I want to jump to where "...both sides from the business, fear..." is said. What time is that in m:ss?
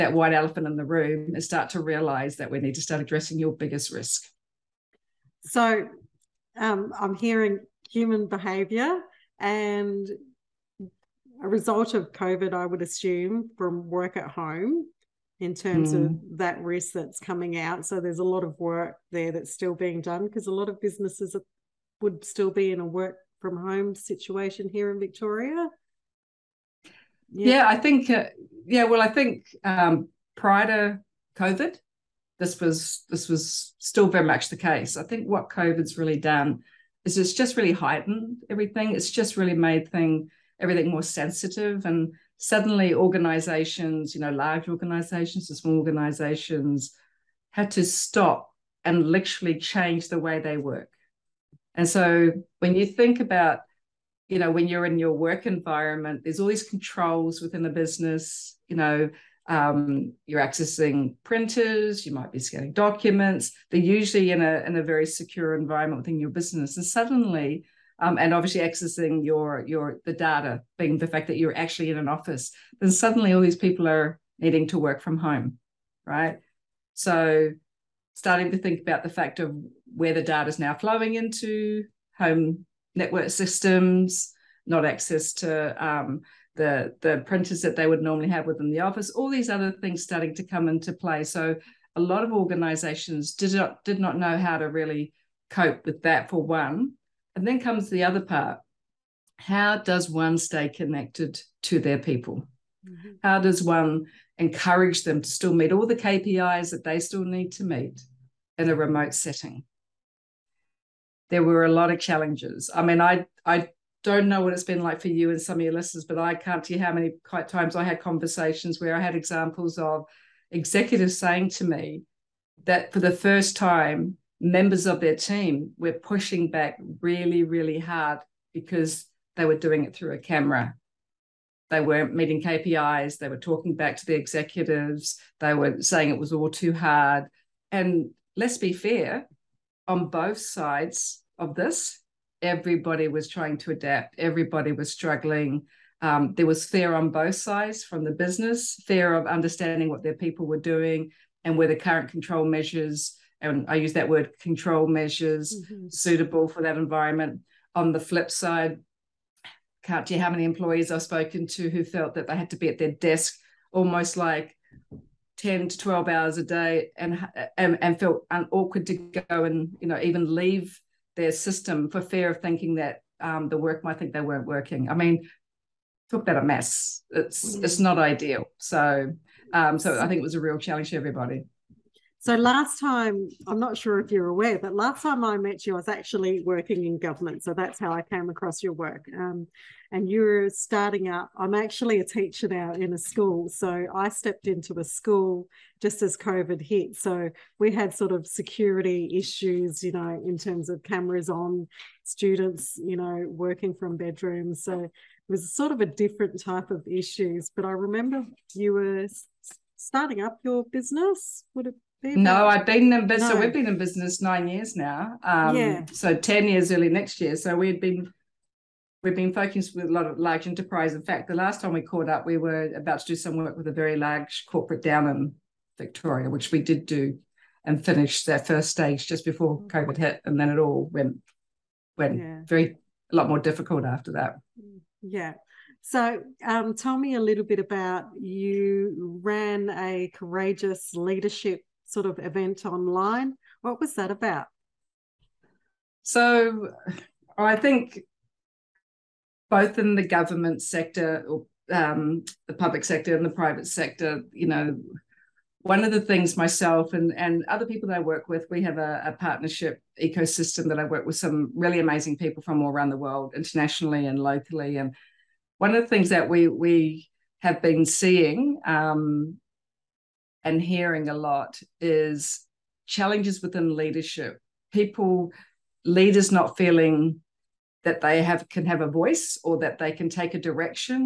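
2:27.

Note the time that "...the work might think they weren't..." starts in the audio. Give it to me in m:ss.
2:53.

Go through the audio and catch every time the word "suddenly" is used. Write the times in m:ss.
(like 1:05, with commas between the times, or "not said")
0:42, 1:06, 1:12.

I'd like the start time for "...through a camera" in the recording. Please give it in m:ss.
2:09.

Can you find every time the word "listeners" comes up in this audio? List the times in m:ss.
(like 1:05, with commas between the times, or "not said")
1:55.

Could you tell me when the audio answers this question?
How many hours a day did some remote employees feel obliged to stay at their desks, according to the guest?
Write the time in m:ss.
2:45.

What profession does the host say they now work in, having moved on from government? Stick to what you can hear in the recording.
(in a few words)
Teacher.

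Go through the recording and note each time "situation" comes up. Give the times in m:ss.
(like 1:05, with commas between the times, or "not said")
0:23.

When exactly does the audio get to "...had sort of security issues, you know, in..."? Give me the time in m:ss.
3:17.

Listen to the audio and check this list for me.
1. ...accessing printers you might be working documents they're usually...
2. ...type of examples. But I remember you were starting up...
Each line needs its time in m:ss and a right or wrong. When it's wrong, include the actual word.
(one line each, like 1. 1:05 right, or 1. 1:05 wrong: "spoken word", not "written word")
1. 1:00 wrong: "scanning", not "working"
2. 3:26 wrong: "issues", not "examples".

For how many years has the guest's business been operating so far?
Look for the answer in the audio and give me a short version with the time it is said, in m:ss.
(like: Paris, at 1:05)
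9, at 3:34.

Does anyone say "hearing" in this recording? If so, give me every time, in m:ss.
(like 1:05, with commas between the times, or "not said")
0:07, 4:30.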